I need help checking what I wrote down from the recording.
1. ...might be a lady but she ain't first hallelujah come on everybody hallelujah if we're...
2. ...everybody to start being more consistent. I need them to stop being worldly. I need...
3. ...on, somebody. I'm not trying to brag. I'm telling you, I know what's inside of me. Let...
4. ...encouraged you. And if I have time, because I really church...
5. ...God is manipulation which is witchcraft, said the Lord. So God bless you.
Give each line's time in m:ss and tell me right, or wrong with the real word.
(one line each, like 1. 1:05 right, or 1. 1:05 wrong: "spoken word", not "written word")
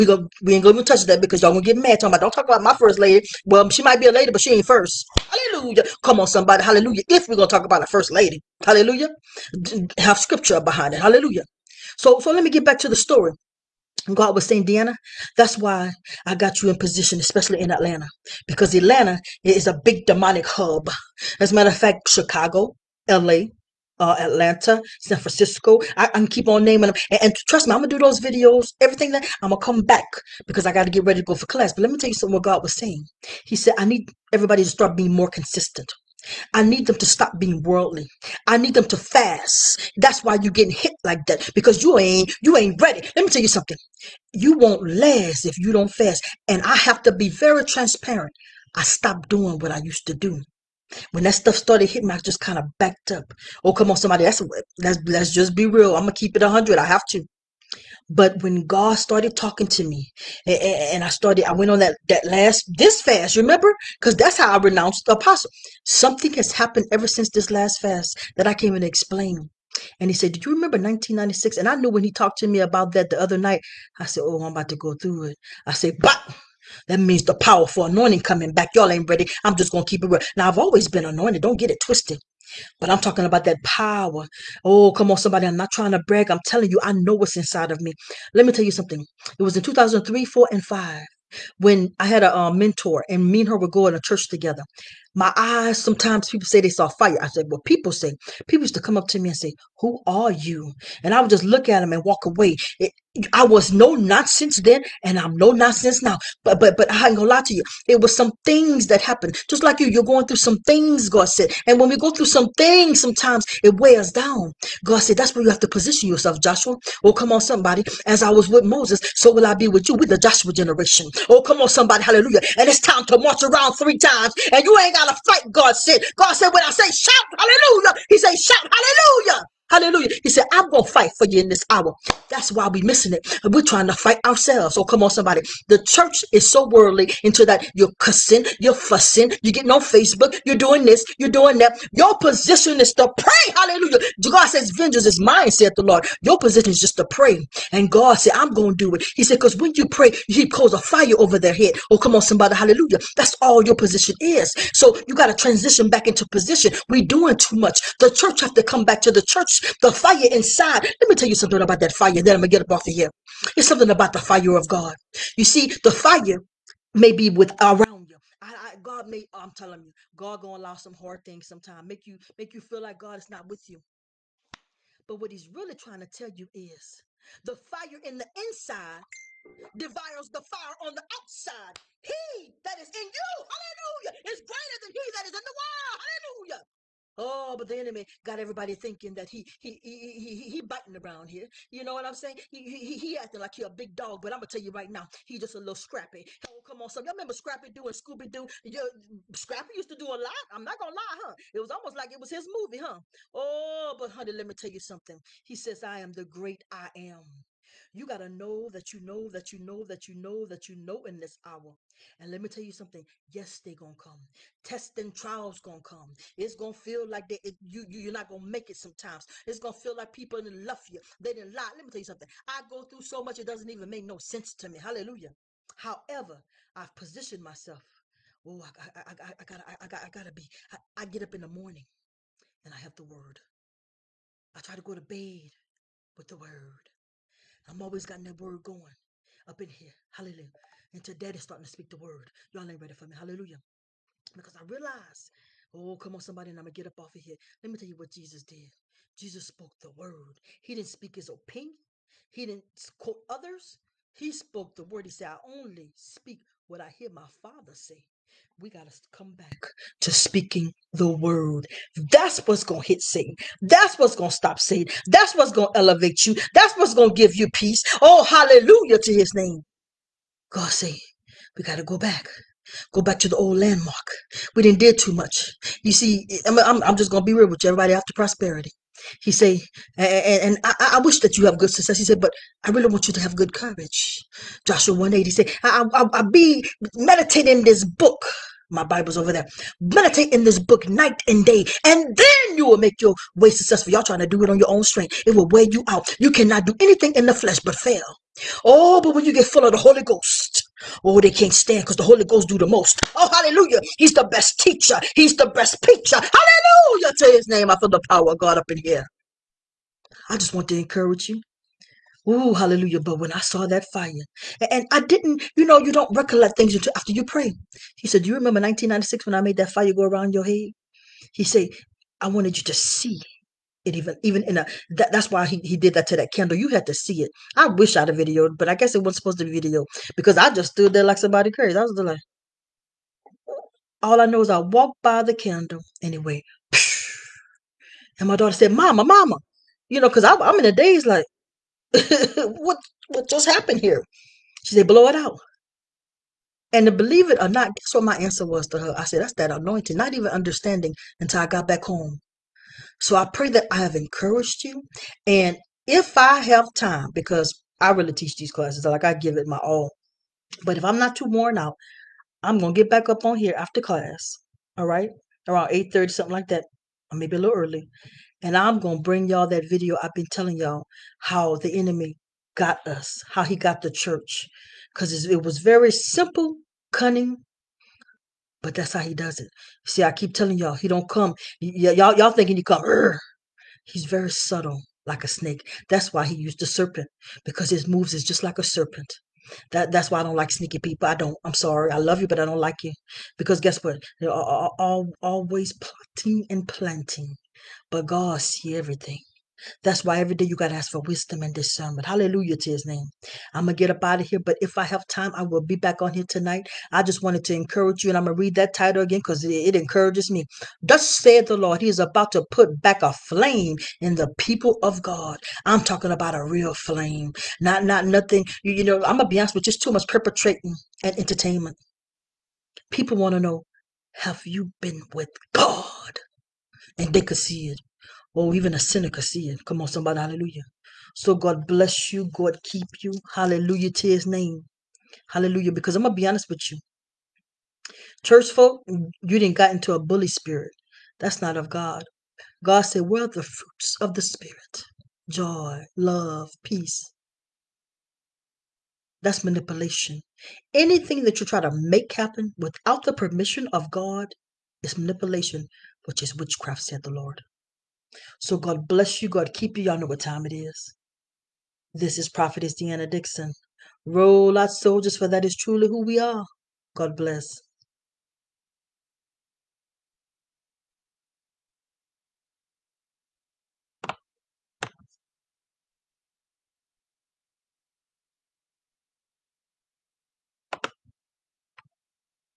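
1. 0:03 wrong: "somebody", not "everybody"
2. 0:34 right
3. 1:25 right
4. 5:53 wrong: "teach", not "church"
5. 7:33 right.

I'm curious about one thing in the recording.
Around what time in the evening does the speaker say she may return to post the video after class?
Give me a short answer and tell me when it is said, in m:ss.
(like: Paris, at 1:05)
8:30, at 6:05.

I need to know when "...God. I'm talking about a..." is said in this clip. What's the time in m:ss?
6:55.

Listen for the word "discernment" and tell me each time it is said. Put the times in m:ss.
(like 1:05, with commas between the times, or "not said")
6:41.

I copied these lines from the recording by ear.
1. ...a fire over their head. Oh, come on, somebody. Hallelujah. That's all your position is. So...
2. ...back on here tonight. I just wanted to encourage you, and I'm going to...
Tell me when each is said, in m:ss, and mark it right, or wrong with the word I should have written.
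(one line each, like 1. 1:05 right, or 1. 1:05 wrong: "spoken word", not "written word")
1. 2:30 right
2. 6:45 right.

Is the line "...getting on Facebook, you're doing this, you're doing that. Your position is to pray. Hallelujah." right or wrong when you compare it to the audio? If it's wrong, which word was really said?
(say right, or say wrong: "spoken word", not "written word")
right.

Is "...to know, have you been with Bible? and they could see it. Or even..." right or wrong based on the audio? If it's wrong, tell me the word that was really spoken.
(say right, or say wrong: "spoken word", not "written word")
wrong: "God", not "Bible".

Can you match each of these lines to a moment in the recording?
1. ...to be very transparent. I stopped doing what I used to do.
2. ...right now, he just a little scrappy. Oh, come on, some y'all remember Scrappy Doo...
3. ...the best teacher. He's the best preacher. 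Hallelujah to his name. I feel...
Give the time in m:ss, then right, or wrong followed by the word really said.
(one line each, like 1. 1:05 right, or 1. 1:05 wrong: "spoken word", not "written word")
1. 0:47 right
2. 3:14 right
3. 5:04 right.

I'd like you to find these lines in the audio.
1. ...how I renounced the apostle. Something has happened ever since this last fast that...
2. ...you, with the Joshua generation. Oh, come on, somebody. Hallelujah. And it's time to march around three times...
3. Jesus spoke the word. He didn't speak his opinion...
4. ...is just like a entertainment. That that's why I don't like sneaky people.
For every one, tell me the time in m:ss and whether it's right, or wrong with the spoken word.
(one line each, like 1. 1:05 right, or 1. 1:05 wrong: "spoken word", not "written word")
1. 1:04 right
2. 1:59 right
3. 4:09 right
4. 6:28 wrong: "serpent", not "entertainment".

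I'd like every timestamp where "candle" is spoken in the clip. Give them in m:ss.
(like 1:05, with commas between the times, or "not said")
5:26, 5:35.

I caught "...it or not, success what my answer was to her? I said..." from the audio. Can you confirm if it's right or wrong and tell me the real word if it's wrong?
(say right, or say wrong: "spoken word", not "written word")
wrong: "guess", not "success".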